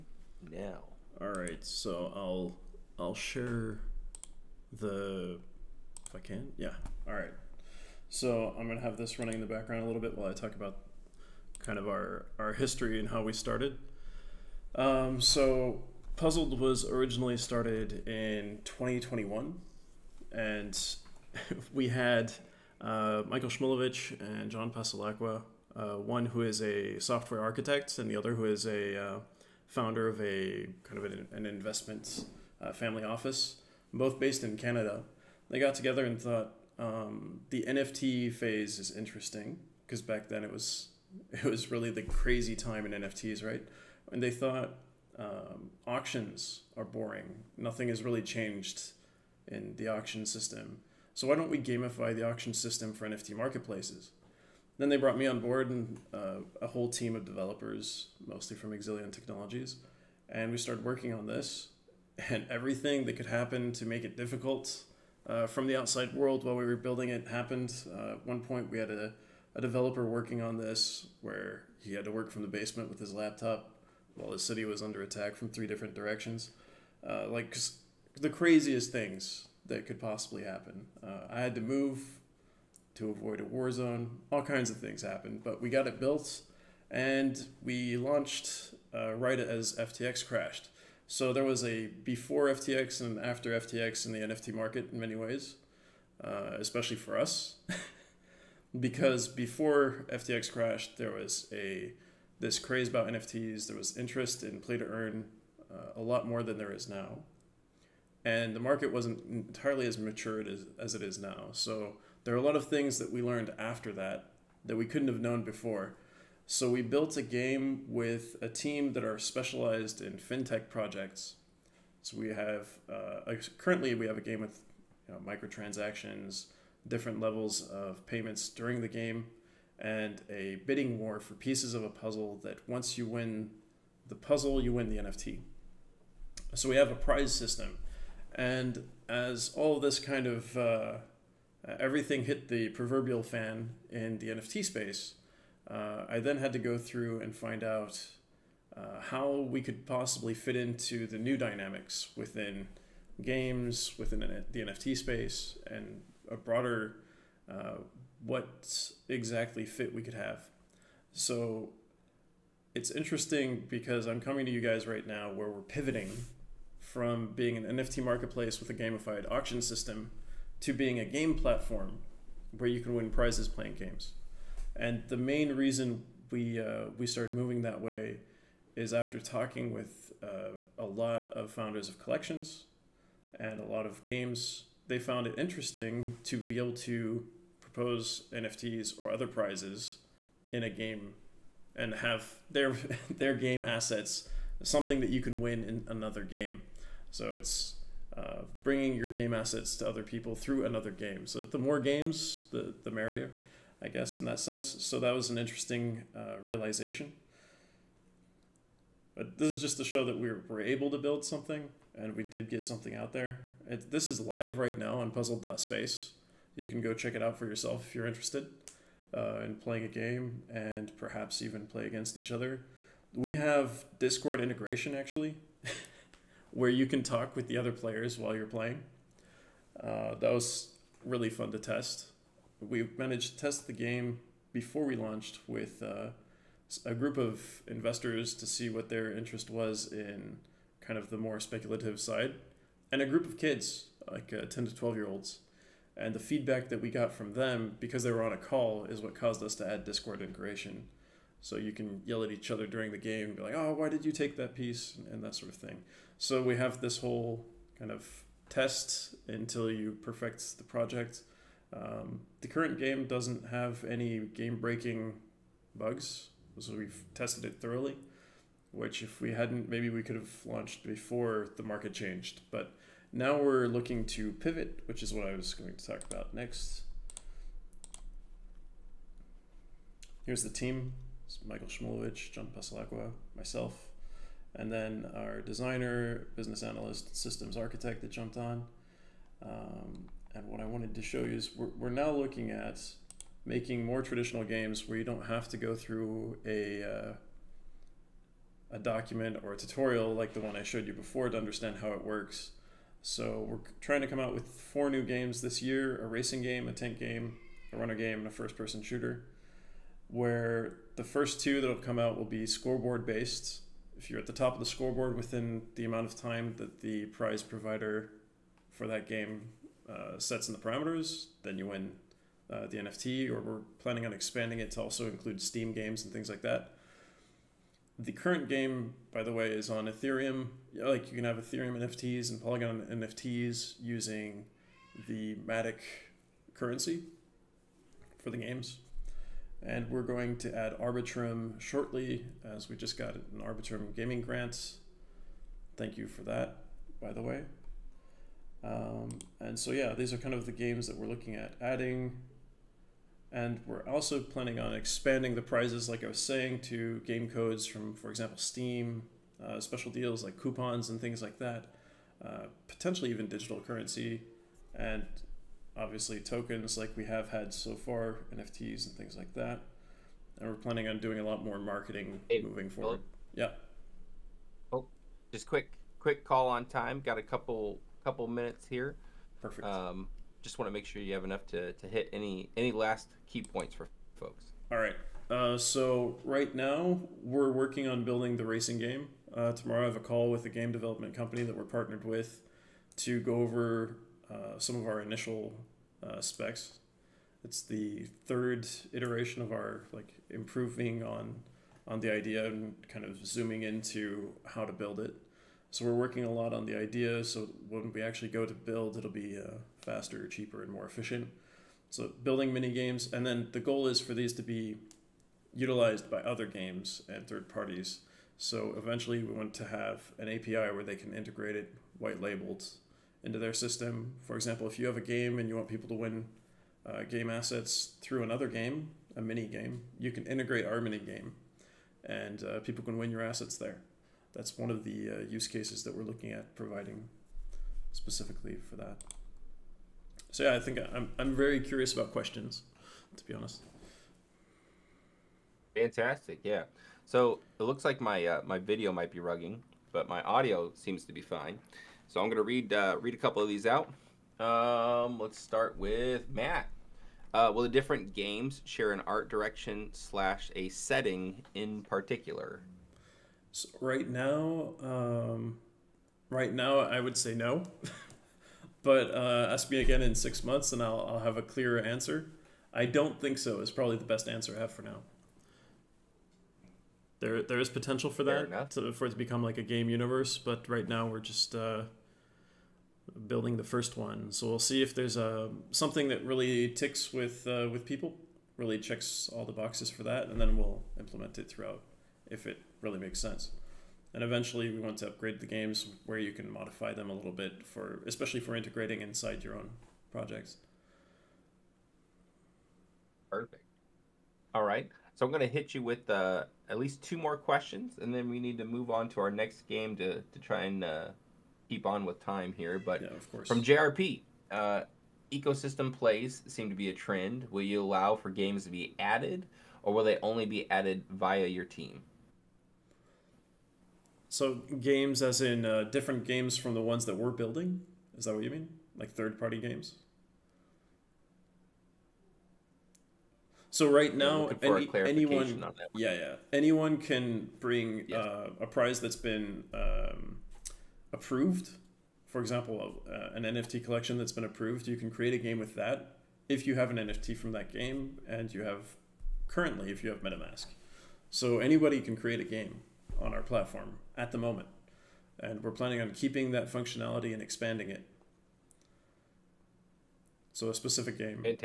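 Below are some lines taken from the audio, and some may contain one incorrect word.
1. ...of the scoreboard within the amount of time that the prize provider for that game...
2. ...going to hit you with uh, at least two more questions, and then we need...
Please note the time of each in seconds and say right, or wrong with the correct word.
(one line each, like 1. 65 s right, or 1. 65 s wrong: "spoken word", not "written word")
1. 314 s right
2. 505 s right.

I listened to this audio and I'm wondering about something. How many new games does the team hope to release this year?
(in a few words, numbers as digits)
4.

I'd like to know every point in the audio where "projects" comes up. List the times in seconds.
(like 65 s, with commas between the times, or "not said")
120 s, 260 s, 500 s.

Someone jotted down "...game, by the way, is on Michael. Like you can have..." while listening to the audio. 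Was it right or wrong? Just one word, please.
wrong.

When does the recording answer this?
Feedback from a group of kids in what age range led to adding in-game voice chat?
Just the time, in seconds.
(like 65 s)
244 s.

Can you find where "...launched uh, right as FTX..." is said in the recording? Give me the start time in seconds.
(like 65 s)
87 s.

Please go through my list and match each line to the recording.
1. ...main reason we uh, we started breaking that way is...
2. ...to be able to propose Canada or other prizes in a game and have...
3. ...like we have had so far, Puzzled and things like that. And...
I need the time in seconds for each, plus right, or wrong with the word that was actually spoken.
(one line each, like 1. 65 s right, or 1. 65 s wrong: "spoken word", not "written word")
1. 175 s wrong: "moving", not "breaking"
2. 186 s wrong: "NFTs", not "Canada"
3. 366 s wrong: "NFTs", not "Puzzled".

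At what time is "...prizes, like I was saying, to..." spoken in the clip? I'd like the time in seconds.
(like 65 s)
355 s.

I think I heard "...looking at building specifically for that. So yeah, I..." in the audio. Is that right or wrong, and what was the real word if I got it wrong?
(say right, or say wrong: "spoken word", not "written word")
wrong: "providing", not "building".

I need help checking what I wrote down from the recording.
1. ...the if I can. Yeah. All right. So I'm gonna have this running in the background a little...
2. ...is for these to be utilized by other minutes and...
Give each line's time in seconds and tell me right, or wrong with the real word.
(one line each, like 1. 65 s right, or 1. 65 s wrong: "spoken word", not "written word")
1. 4 s right
2. 413 s wrong: "games", not "minutes".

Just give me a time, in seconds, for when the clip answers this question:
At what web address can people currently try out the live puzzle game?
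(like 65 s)
215 s.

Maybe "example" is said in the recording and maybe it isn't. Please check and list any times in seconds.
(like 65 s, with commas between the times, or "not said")
358 s, 424 s, 542 s.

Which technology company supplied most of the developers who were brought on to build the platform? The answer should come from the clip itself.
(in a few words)
Exilion Technologies.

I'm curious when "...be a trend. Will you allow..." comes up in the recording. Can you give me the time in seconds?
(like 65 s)
516 s.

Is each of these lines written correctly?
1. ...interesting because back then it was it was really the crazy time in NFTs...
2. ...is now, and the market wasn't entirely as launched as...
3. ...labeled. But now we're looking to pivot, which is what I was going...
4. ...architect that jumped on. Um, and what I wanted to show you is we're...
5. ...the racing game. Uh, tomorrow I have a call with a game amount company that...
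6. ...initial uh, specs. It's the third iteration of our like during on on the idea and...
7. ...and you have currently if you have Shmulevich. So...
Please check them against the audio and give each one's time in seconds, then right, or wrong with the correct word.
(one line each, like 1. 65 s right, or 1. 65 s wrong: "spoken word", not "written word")
1. 38 s right
2. 106 s wrong: "matured", not "launched"
3. 271 s wrong: "changed", not "labeled"
4. 287 s right
5. 388 s wrong: "development", not "amount"
6. 395 s wrong: "improving", not "during"
7. 548 s wrong: "MetaMask", not "Shmulevich".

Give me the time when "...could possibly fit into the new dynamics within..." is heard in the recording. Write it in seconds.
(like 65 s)
149 s.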